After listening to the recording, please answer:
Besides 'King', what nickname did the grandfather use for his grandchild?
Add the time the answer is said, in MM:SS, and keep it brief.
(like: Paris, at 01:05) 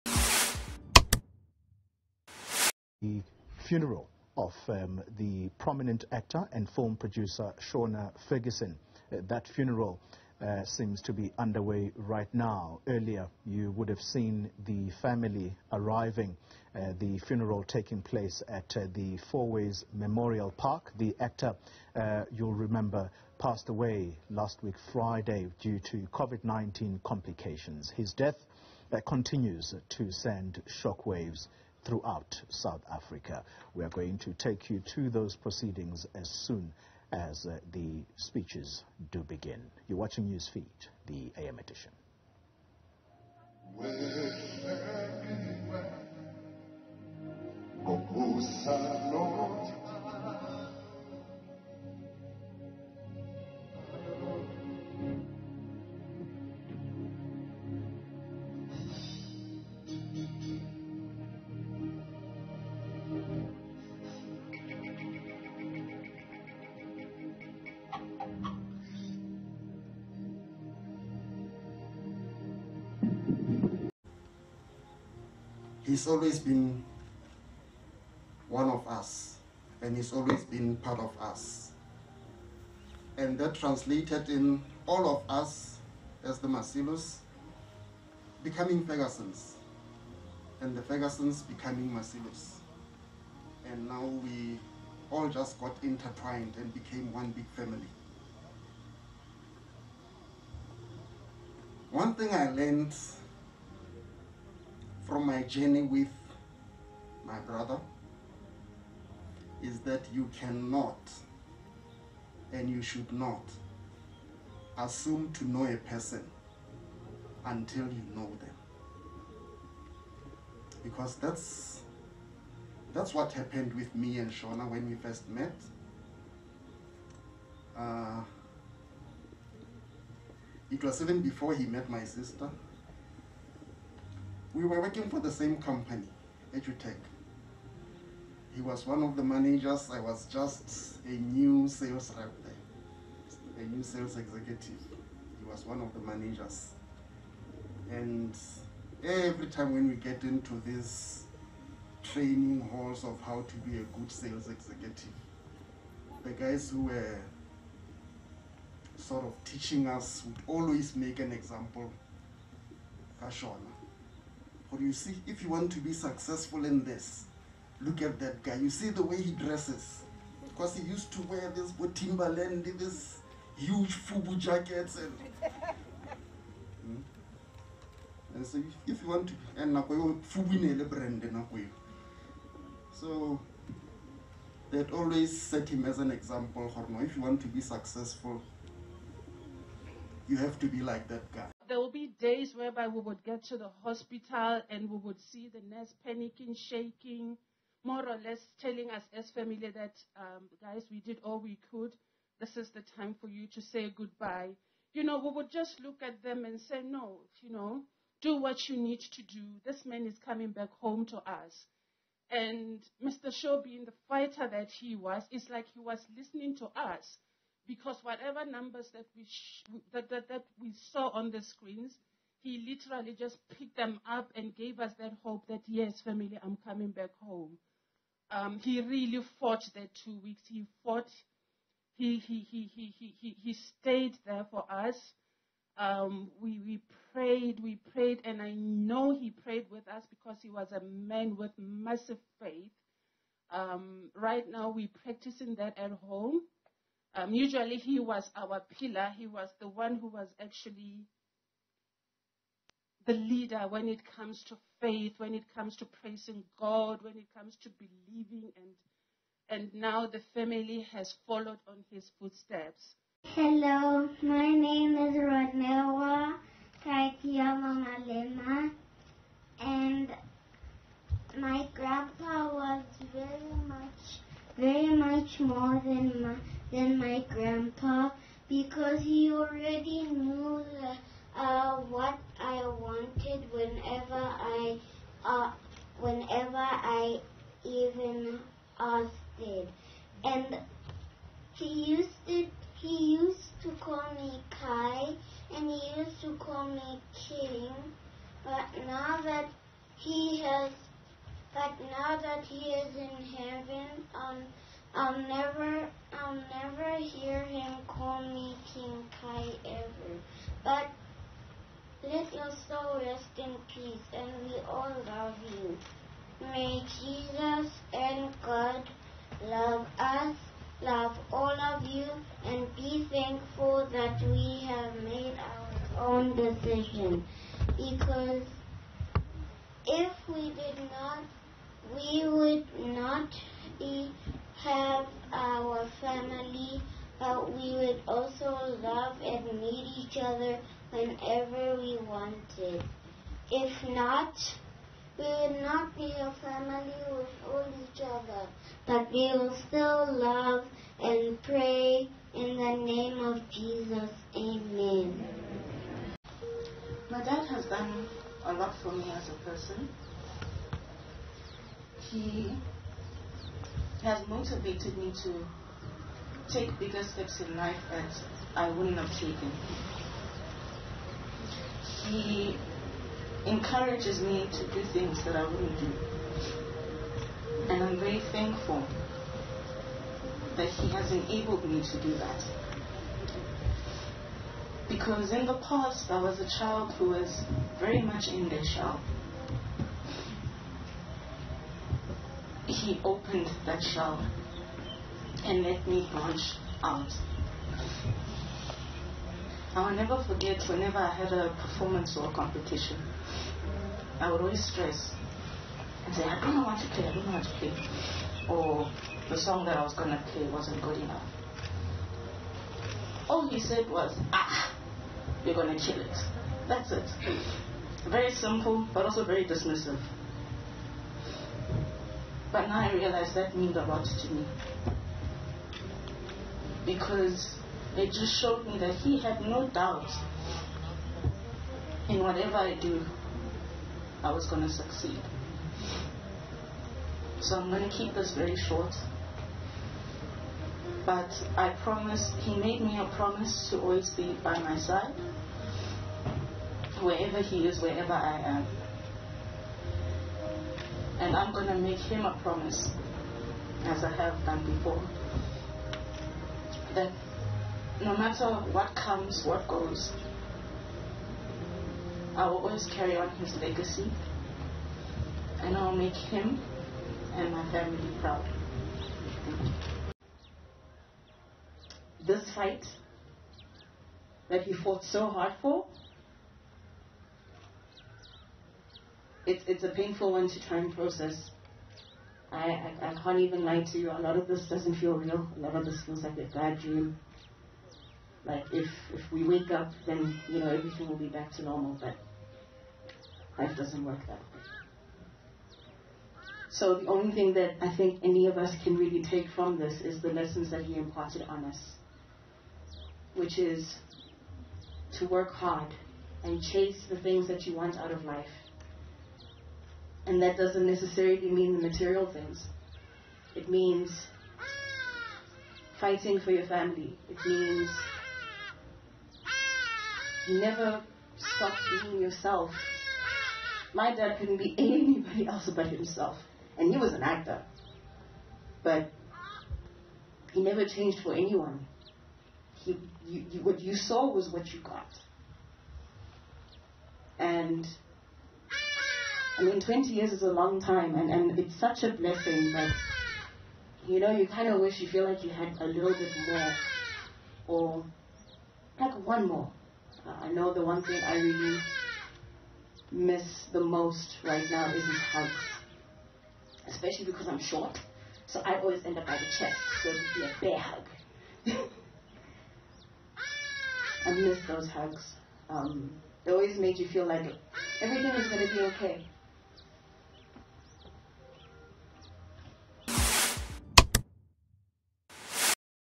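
Kai, at 04:54.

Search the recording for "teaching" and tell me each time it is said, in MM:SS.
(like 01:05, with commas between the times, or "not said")
02:39.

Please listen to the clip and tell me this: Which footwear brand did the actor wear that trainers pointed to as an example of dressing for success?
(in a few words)
Timberland.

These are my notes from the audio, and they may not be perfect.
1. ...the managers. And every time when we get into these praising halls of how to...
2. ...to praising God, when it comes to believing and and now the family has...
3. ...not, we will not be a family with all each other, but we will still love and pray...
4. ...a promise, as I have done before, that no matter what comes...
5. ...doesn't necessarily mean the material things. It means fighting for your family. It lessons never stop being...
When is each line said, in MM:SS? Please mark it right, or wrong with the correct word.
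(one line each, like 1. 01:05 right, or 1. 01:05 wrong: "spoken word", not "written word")
1. 02:25 wrong: "training", not "praising"
2. 04:15 right
3. 05:43 right
4. 07:32 right
5. 08:30 wrong: "means", not "lessons".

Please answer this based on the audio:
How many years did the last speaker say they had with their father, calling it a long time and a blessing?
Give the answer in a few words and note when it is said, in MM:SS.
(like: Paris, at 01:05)
20, at 08:59.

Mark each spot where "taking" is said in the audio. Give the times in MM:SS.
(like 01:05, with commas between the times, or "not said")
00:17.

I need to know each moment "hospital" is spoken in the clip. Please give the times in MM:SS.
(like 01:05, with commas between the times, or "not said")
03:13.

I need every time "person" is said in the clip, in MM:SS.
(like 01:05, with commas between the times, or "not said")
01:55, 05:59.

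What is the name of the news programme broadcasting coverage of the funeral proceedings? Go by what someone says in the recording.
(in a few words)
Newsfeed.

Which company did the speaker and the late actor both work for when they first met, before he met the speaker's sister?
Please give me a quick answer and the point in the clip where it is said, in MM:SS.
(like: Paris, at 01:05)
EduTech, at 02:16.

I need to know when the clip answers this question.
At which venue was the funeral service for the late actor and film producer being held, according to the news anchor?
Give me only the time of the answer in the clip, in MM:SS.
00:19.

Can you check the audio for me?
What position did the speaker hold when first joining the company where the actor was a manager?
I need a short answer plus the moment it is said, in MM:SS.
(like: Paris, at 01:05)
Sales rep, at 02:21.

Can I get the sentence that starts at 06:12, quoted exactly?
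He encourages me to do things that I wouldn't do.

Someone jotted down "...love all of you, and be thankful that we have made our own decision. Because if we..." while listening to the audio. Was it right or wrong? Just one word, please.
right.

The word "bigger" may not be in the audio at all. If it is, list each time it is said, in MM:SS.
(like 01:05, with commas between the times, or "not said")
06:06.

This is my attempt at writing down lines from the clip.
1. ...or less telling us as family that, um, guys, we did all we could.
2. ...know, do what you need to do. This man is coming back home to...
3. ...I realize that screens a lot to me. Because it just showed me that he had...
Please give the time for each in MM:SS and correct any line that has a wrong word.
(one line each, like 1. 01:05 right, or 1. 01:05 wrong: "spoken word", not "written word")
1. 03:18 right
2. 03:27 right
3. 07:02 wrong: "means", not "screens".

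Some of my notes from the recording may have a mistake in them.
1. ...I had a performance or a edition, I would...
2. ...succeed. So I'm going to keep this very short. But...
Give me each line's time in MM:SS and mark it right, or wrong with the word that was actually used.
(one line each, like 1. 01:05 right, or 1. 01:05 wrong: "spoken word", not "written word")
1. 06:40 wrong: "competition", not "edition"
2. 07:14 right.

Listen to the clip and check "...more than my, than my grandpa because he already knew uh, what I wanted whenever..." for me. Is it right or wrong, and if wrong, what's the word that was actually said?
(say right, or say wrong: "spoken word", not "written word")
right.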